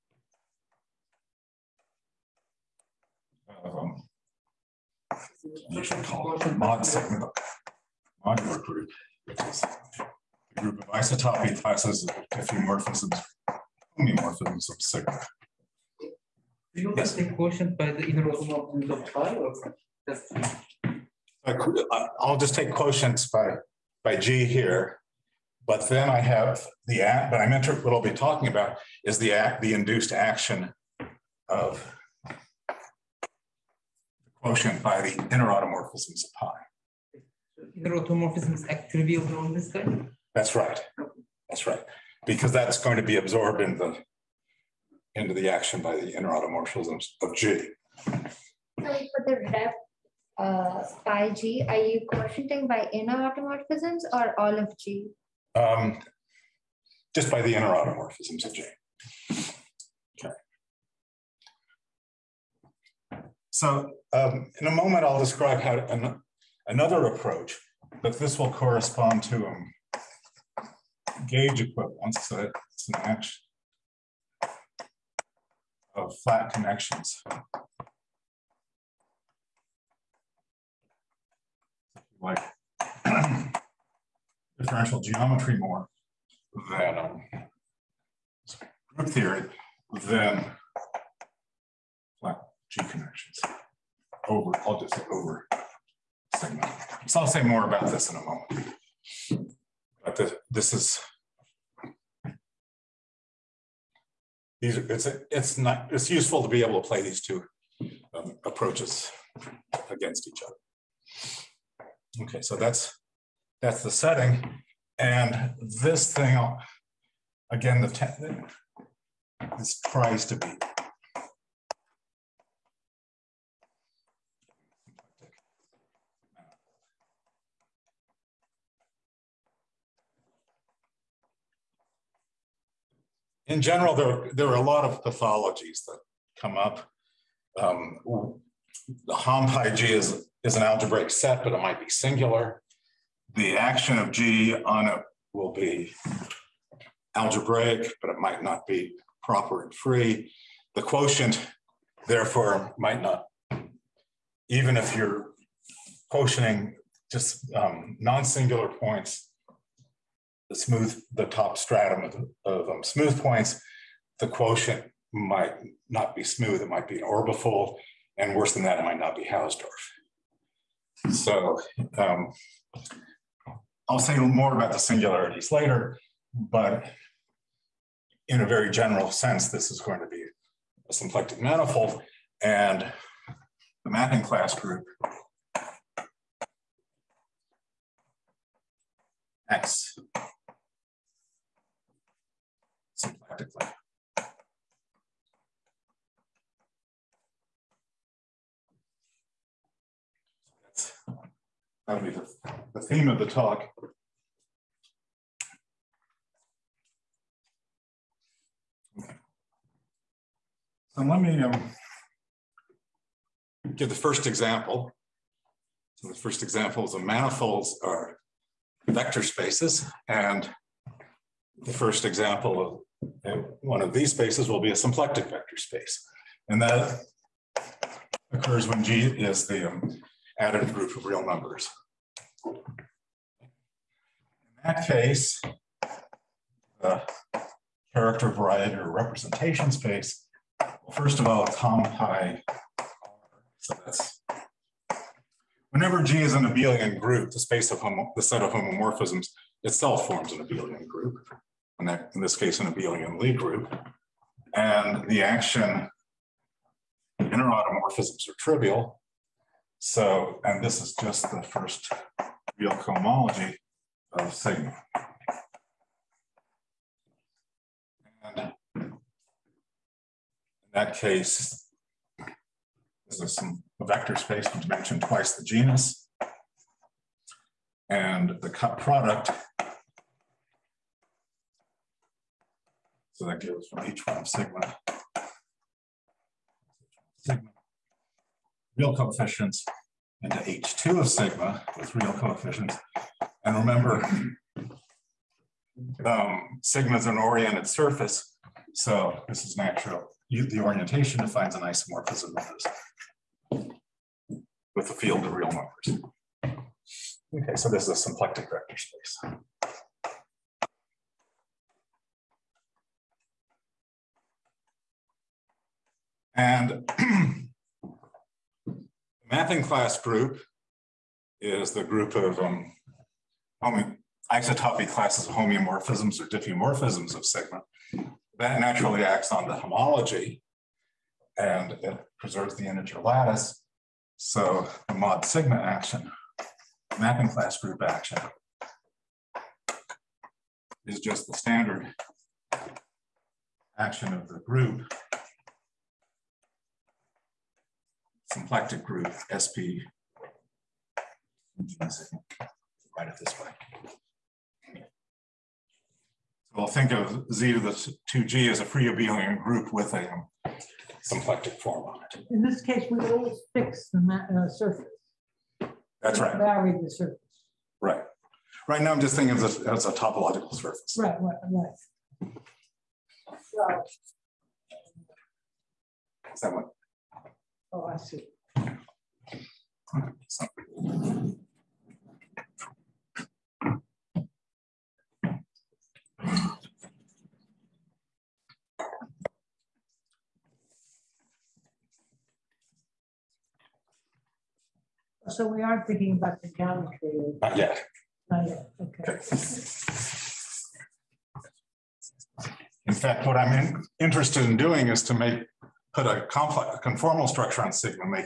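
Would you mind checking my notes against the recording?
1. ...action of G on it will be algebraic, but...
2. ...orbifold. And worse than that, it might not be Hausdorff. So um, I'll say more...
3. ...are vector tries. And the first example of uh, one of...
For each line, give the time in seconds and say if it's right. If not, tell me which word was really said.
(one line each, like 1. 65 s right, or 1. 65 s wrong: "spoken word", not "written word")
1. 143 s right
2. 167 s right
3. 217 s wrong: "spaces", not "tries".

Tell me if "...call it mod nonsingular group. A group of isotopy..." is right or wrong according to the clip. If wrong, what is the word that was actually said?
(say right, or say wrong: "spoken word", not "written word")
wrong: "modular", not "nonsingular".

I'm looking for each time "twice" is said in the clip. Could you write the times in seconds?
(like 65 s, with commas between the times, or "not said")
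274 s.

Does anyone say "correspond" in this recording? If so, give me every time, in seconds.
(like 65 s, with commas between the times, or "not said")
68 s.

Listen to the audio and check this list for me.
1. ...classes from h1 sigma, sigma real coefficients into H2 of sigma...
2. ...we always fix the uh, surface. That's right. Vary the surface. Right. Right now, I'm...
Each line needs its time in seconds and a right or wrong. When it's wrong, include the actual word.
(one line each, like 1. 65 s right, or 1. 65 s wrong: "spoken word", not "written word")
1. 283 s wrong: "gives", not "classes"
2. 362 s right.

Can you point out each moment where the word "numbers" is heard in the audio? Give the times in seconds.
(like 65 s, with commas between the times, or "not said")
231 s, 305 s.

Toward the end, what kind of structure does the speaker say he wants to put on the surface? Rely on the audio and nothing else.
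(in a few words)
conformal structure.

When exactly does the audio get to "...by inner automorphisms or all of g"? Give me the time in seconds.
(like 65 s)
52 s.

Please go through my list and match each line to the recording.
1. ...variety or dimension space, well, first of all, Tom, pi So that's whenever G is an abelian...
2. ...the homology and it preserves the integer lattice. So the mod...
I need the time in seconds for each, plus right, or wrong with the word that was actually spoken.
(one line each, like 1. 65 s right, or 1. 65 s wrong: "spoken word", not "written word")
1. 238 s wrong: "representation", not "dimension"
2. 329 s right.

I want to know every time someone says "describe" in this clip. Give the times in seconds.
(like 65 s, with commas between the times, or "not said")
65 s.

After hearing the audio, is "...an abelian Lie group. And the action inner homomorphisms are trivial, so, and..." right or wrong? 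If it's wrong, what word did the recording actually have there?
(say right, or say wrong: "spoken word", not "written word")
wrong: "automorphisms", not "homomorphisms".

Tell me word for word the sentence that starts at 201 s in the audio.
that'll be the, the theme of the talk.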